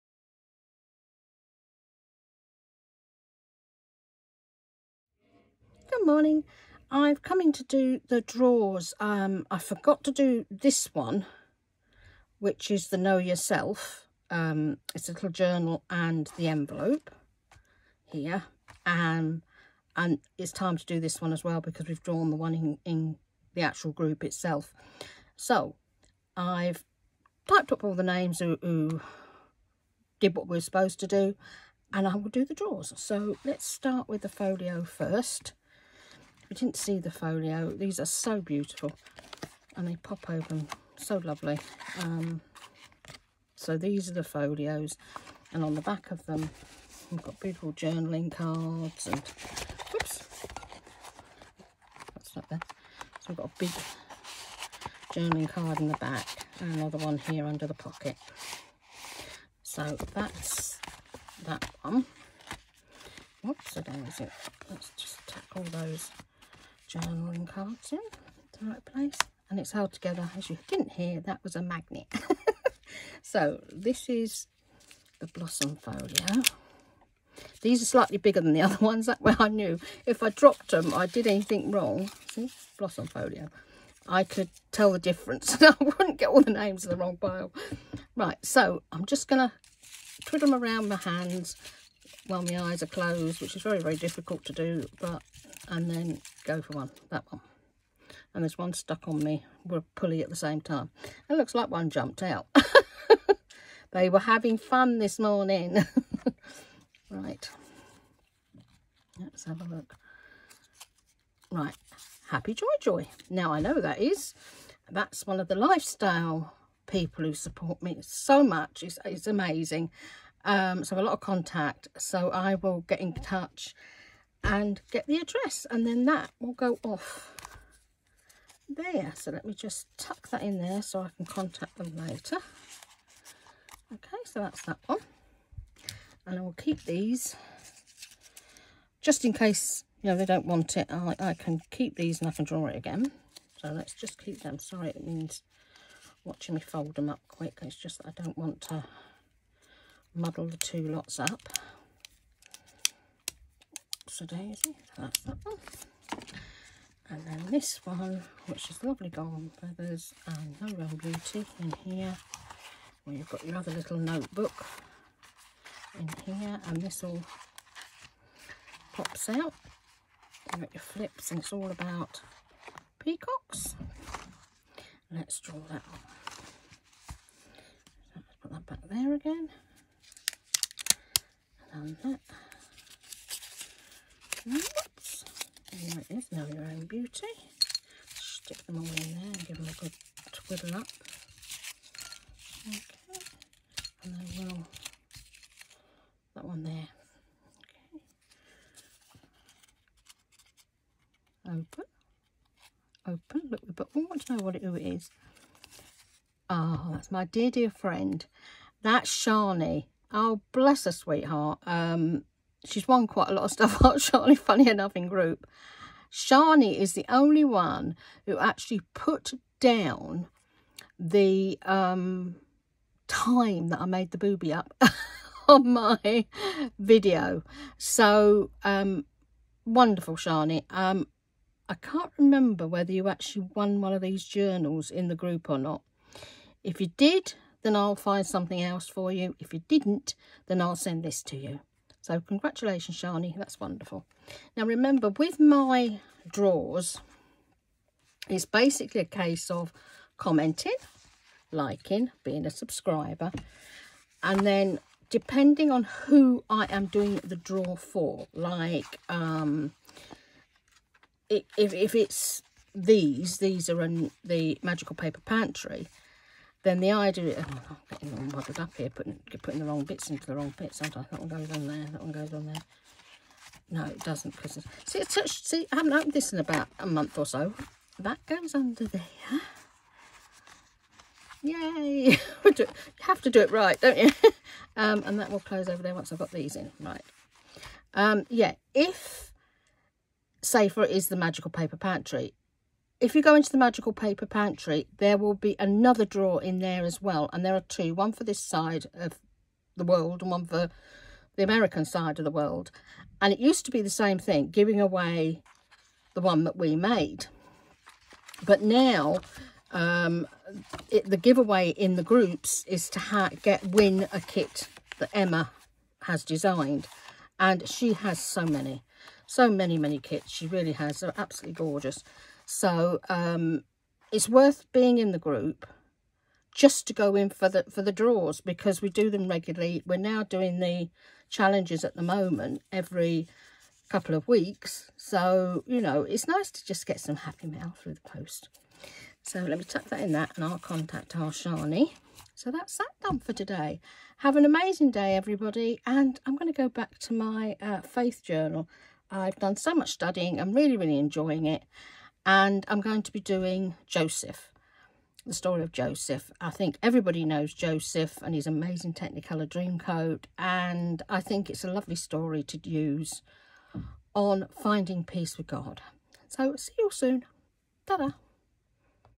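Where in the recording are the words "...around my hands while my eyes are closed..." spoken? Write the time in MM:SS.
01:30.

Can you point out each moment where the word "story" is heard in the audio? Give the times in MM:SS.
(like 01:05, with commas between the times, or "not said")
05:55, 06:01.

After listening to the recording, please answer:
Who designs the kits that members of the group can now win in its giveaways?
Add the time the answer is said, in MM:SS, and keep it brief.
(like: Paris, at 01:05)
Emma, at 05:15.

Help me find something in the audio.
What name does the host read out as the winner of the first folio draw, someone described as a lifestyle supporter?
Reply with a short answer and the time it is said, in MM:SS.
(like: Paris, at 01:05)
Happy Joy Joy, at 01:52.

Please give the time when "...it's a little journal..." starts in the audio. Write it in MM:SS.
00:14.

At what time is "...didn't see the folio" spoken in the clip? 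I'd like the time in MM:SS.
00:36.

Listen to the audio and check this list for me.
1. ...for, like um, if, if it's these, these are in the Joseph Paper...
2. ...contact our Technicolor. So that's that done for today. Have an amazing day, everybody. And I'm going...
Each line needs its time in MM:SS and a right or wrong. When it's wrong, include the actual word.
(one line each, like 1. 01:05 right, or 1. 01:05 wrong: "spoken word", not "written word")
1. 04:17 wrong: "Magical", not "Joseph"
2. 05:40 wrong: "Shani", not "Technicolor".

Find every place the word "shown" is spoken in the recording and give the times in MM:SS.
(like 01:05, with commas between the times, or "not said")
not said.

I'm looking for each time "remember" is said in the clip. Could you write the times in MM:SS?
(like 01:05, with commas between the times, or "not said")
03:52, 04:04.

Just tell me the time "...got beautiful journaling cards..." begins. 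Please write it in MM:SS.
00:47.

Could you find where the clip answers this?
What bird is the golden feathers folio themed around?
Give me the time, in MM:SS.
02:52.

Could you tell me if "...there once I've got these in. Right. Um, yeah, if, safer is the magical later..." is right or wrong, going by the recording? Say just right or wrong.
wrong.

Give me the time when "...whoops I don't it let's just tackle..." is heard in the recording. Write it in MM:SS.
01:03.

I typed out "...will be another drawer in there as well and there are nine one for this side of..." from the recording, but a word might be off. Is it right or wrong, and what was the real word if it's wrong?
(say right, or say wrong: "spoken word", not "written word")
wrong: "two", not "nine".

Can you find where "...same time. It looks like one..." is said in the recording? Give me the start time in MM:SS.
01:40.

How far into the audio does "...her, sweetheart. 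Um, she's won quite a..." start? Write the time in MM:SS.
03:30.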